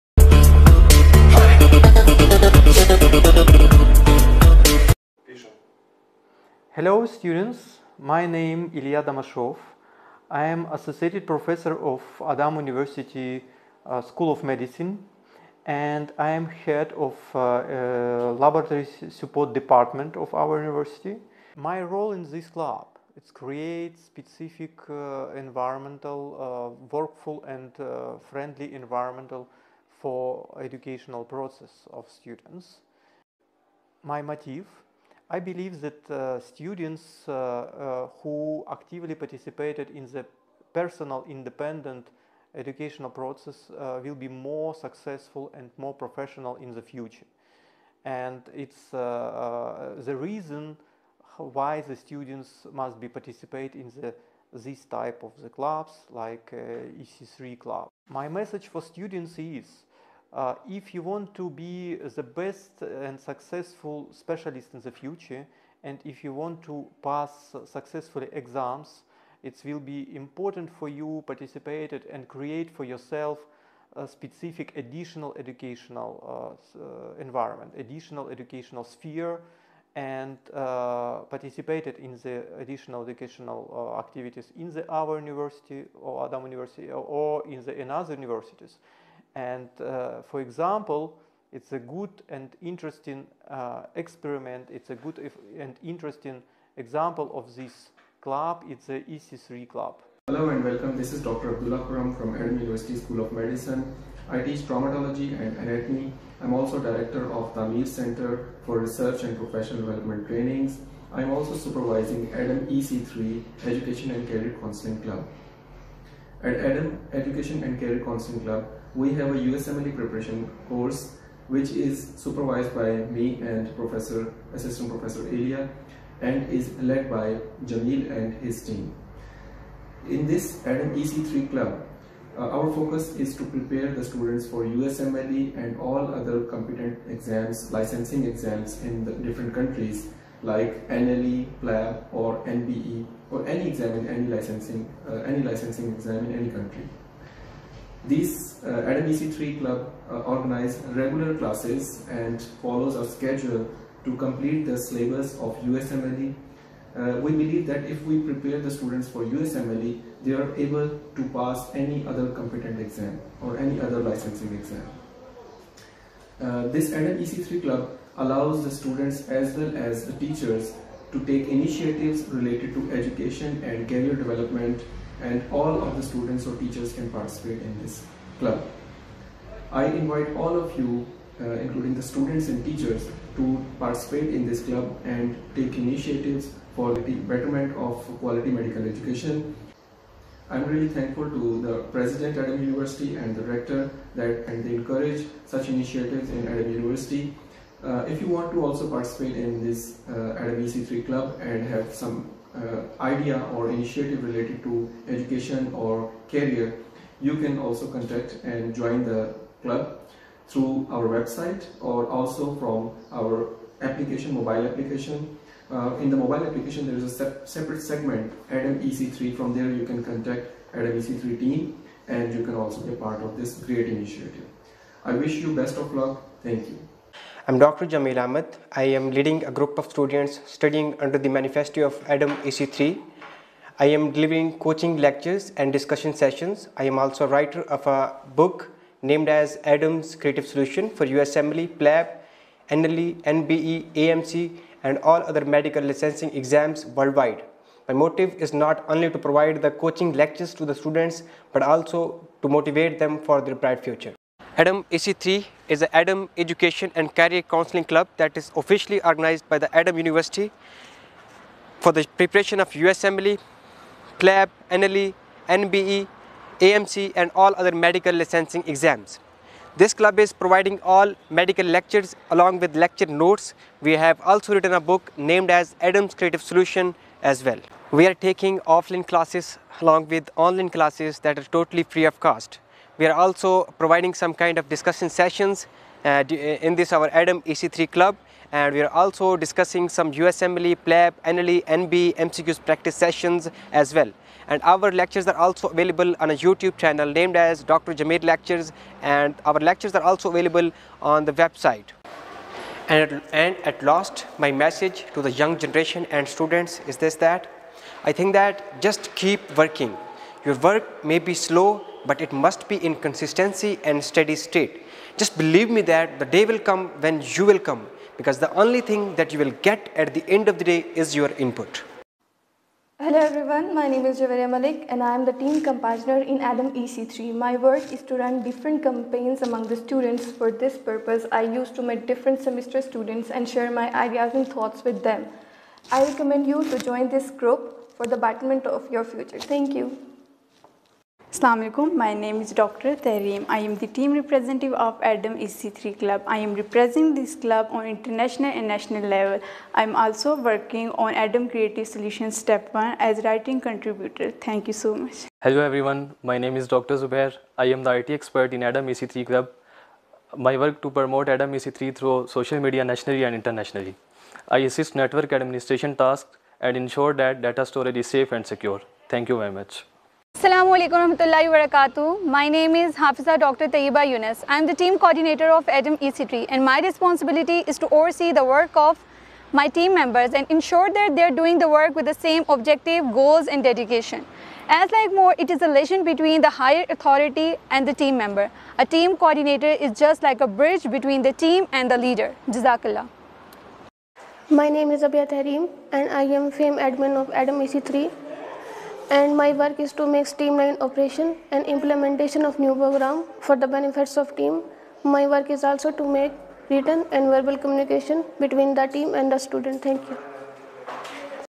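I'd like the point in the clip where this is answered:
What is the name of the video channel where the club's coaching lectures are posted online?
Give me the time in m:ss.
4:57.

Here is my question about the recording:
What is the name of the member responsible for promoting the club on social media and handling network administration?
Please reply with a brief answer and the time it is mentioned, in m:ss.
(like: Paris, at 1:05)
Dr. Zubair, at 5:56.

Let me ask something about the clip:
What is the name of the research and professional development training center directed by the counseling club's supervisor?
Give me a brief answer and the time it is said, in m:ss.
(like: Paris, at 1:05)
Amir Center, at 1:47.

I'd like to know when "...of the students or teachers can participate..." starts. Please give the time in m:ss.
2:55.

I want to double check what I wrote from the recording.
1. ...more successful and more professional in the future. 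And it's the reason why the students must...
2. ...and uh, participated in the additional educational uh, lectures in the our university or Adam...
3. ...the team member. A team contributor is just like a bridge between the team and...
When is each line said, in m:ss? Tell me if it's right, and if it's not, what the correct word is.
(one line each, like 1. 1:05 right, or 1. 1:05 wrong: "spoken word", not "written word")
1. 0:44 right
2. 1:19 wrong: "activities", not "lectures"
3. 6:27 wrong: "coordinator", not "contributor".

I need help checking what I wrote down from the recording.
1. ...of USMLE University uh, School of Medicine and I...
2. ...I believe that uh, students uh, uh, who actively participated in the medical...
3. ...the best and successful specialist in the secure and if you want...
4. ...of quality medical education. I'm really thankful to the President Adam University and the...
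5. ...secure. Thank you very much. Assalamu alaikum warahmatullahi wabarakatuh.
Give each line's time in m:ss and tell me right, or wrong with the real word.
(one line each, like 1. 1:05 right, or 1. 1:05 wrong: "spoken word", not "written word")
1. 0:11 wrong: "Adam", not "USMLE"
2. 0:35 wrong: "personal", not "medical"
3. 1:01 wrong: "future", not "secure"
4. 3:07 right
5. 6:08 right.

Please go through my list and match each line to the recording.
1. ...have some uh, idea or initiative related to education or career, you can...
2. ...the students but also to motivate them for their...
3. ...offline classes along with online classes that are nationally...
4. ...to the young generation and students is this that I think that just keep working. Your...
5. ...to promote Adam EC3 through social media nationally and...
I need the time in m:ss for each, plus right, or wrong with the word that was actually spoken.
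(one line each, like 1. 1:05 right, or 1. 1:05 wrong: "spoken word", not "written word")
1. 3:21 right
2. 4:10 right
3. 4:38 wrong: "totally", not "nationally"
4. 5:05 right
5. 6:00 right.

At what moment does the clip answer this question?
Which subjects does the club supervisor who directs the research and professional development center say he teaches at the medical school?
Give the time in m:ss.
1:44.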